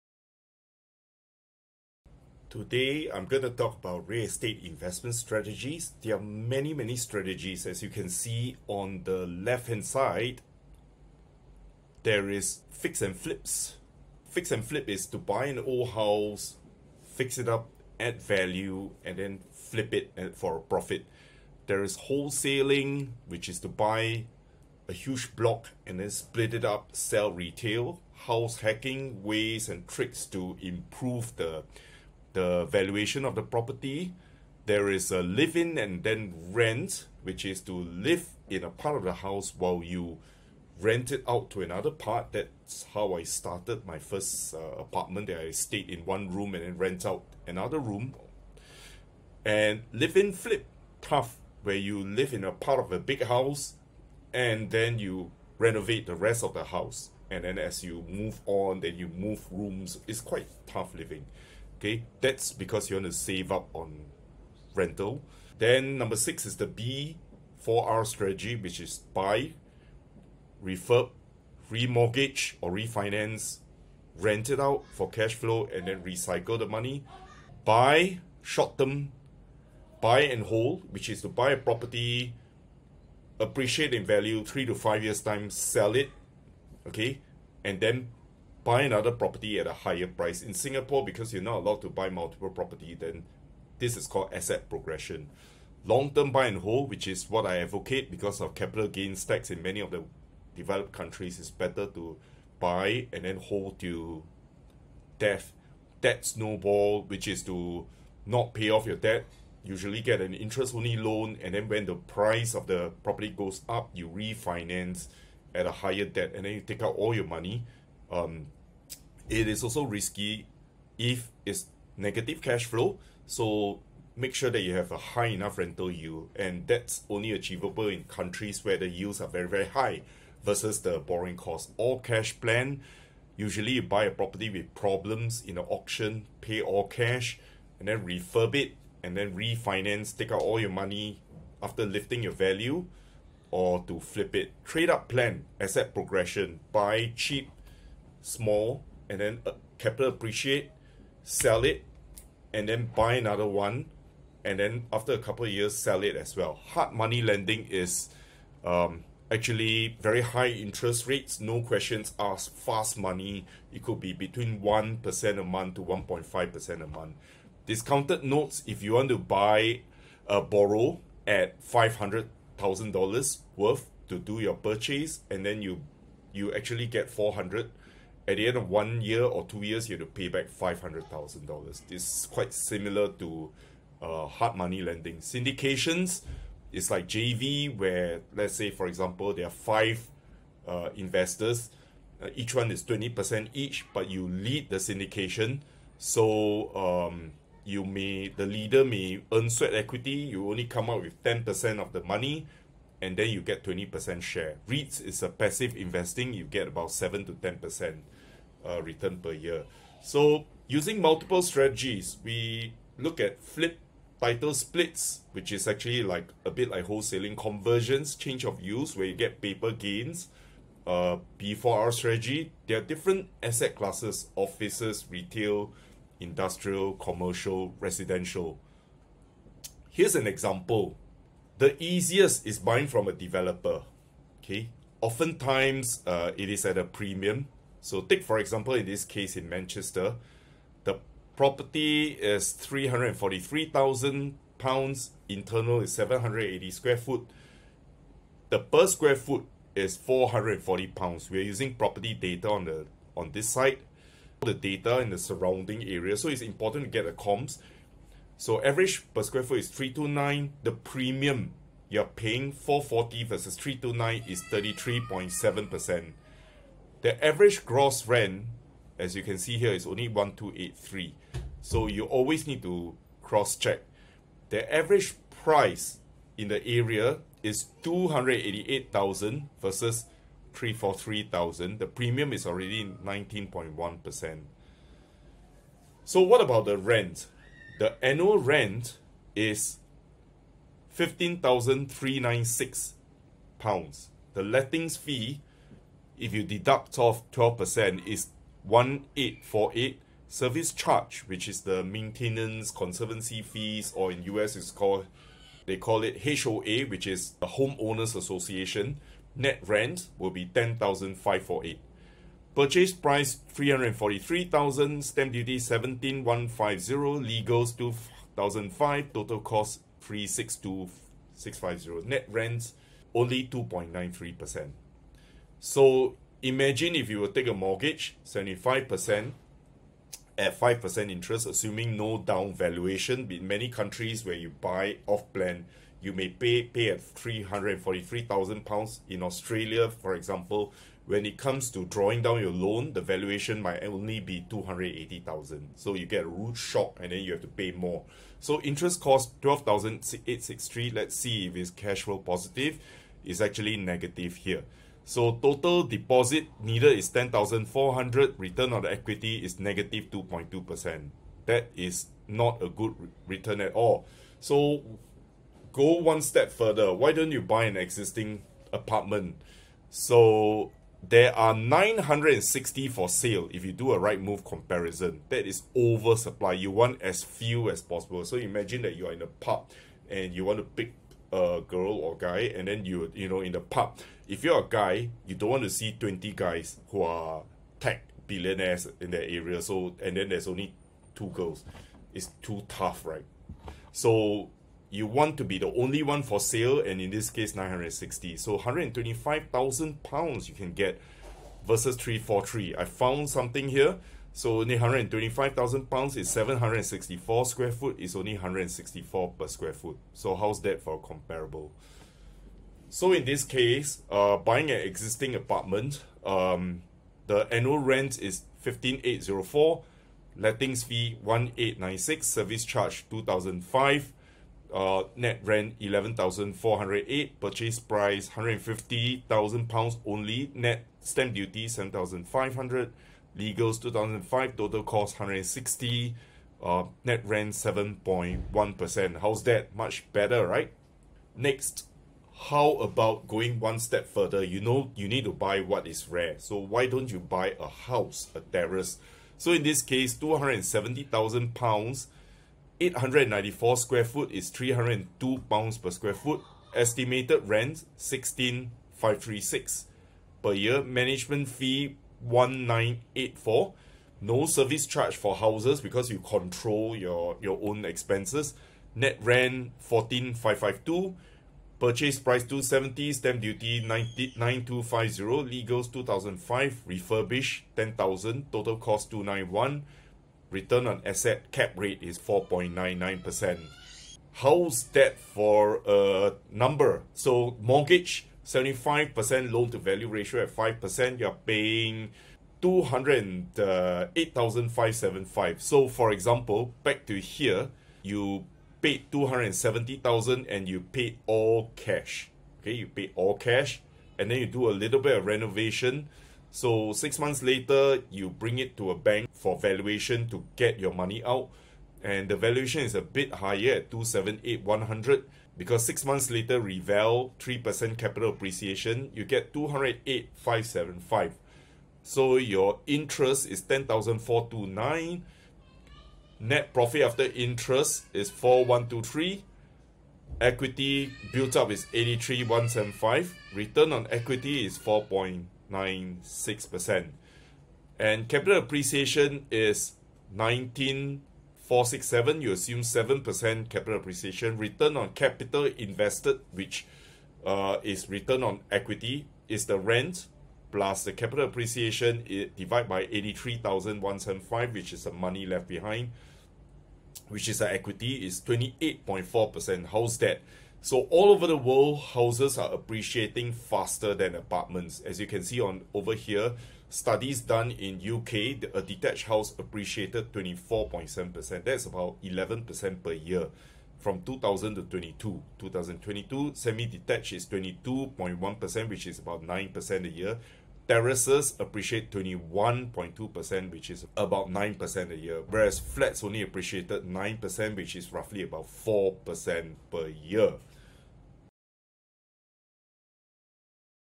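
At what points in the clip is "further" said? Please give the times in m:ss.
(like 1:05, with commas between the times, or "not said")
6:06, 7:24.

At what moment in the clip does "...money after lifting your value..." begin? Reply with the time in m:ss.
2:20.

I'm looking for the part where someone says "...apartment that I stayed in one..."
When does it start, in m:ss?
0:44.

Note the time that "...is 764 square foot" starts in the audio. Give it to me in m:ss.
6:46.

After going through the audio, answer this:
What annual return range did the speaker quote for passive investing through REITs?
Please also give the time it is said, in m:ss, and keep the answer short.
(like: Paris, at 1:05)
7 to 10%, at 3:26.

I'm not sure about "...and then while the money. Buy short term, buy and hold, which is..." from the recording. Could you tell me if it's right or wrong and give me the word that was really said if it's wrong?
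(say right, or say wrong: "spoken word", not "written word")
wrong: "recycle", not "while".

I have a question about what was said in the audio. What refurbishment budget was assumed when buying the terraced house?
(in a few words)
£10,000.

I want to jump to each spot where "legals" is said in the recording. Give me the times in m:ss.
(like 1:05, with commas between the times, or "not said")
5:17, 7:13, 7:55.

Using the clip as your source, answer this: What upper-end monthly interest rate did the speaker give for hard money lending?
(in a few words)
1.5% a month.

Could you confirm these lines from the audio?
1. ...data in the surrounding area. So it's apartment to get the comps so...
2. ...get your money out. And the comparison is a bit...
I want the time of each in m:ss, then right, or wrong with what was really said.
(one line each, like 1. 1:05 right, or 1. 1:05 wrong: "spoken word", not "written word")
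1. 4:14 wrong: "important", not "apartment"
2. 8:30 wrong: "valuation", not "comparison".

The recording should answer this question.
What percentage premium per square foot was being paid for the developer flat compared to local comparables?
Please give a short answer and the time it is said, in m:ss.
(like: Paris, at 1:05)
33.7%, at 4:24.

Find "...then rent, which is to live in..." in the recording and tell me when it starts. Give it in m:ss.
0:36.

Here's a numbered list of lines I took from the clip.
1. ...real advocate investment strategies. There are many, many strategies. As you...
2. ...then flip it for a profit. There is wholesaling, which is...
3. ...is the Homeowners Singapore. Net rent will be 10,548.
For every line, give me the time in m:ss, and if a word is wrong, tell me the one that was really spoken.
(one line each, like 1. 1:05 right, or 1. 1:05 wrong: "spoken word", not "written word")
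1. 0:04 wrong: "estate", not "advocate"
2. 0:19 right
3. 5:07 wrong: "Association", not "Singapore".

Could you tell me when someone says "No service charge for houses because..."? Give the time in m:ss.
7:44.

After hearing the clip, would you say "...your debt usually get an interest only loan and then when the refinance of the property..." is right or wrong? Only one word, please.
wrong.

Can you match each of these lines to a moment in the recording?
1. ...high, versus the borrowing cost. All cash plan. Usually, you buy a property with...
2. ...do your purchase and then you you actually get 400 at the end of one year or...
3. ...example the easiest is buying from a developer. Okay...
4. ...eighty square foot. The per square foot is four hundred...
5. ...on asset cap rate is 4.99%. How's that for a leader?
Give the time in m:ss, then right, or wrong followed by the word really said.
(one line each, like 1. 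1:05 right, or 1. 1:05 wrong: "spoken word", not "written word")
1. 2:09 right
2. 2:54 right
3. 3:50 right
4. 4:06 right
5. 8:00 wrong: "number", not "leader".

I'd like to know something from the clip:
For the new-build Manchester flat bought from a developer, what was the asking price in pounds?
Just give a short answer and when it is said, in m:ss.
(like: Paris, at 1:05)
£343,000, at 4:02.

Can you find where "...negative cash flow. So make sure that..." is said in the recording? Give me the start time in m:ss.
2:01.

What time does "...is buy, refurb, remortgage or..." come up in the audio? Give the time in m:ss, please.
1:08.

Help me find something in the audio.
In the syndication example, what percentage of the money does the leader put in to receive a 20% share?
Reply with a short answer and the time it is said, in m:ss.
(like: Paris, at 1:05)
10%, at 3:21.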